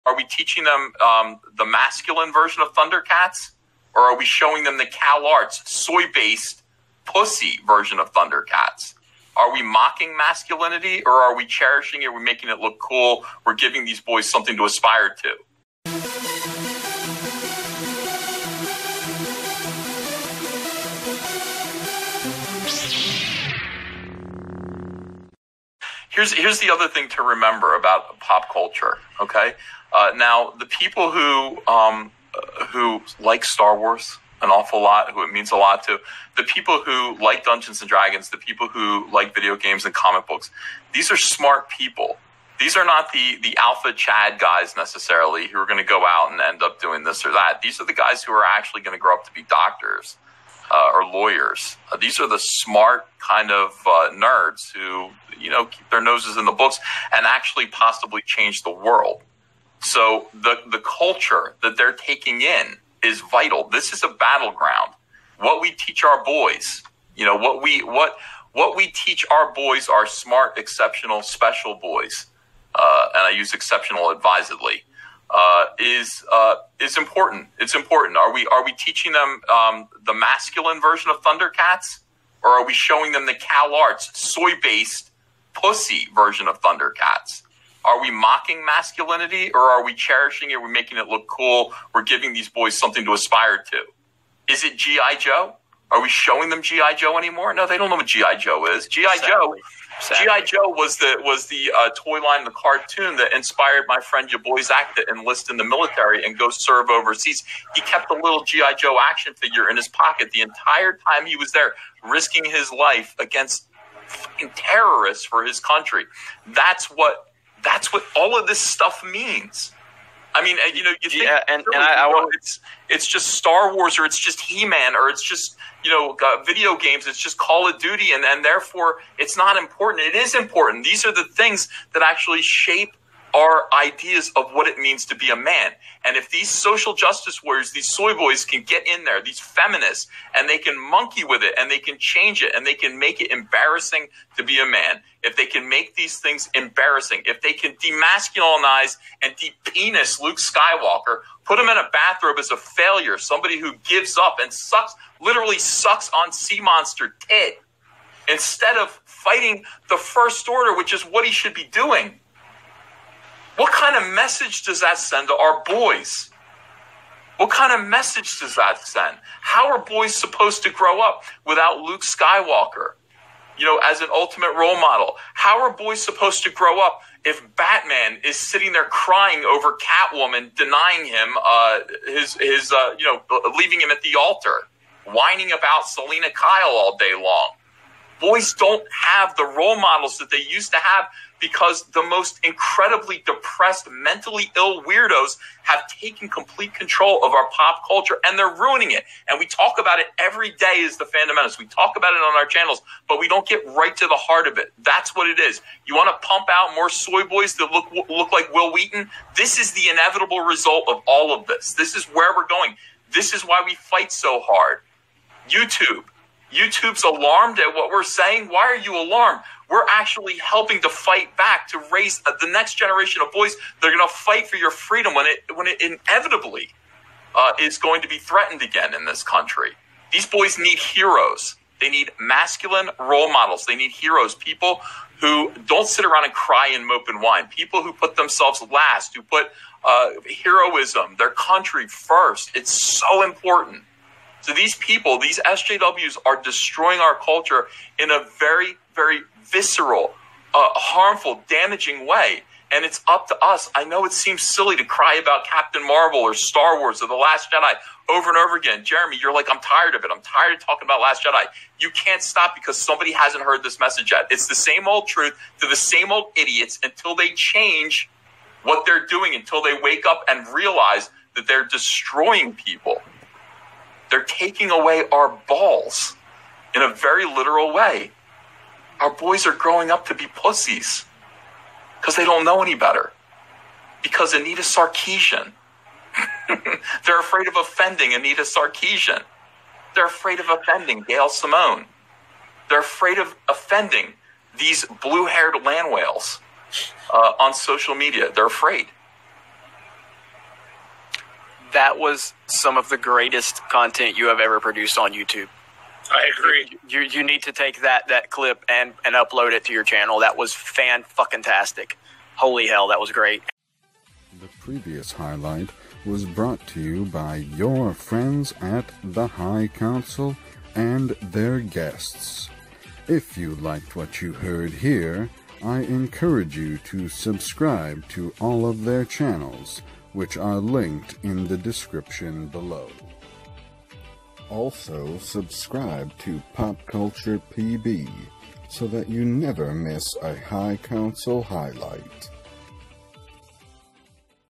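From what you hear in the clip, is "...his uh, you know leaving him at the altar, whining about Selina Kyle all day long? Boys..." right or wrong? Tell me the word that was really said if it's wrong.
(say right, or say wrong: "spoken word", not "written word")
right.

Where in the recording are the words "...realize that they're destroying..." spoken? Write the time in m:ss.
4:30.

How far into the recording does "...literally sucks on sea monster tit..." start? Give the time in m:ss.
2:35.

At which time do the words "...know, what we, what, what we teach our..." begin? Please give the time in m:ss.
1:07.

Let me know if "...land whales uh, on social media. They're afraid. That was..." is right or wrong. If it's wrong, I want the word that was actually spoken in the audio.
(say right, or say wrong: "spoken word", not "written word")
right.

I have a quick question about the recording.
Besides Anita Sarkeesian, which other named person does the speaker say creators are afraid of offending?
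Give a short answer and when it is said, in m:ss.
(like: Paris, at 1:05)
Gail Simone, at 4:51.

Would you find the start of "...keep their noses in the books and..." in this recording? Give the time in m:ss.
0:55.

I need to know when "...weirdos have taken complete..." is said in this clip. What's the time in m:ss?
3:14.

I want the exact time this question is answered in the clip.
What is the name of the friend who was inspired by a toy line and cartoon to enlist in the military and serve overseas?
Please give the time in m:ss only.
1:44.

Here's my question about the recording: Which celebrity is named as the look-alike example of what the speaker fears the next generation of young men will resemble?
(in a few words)
Wil Wheaton.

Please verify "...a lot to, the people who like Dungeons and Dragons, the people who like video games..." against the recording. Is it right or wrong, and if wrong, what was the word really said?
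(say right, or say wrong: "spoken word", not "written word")
right.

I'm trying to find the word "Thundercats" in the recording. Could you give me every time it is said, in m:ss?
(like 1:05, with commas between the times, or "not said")
0:02, 0:08, 1:21, 1:26.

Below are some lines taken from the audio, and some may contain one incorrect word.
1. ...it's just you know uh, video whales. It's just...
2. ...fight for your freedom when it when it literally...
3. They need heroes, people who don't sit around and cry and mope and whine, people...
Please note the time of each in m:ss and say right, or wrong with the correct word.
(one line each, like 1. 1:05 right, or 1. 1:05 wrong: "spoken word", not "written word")
1. 2:05 wrong: "games", not "whales"
2. 3:44 wrong: "inevitably", not "literally"
3. 3:53 right.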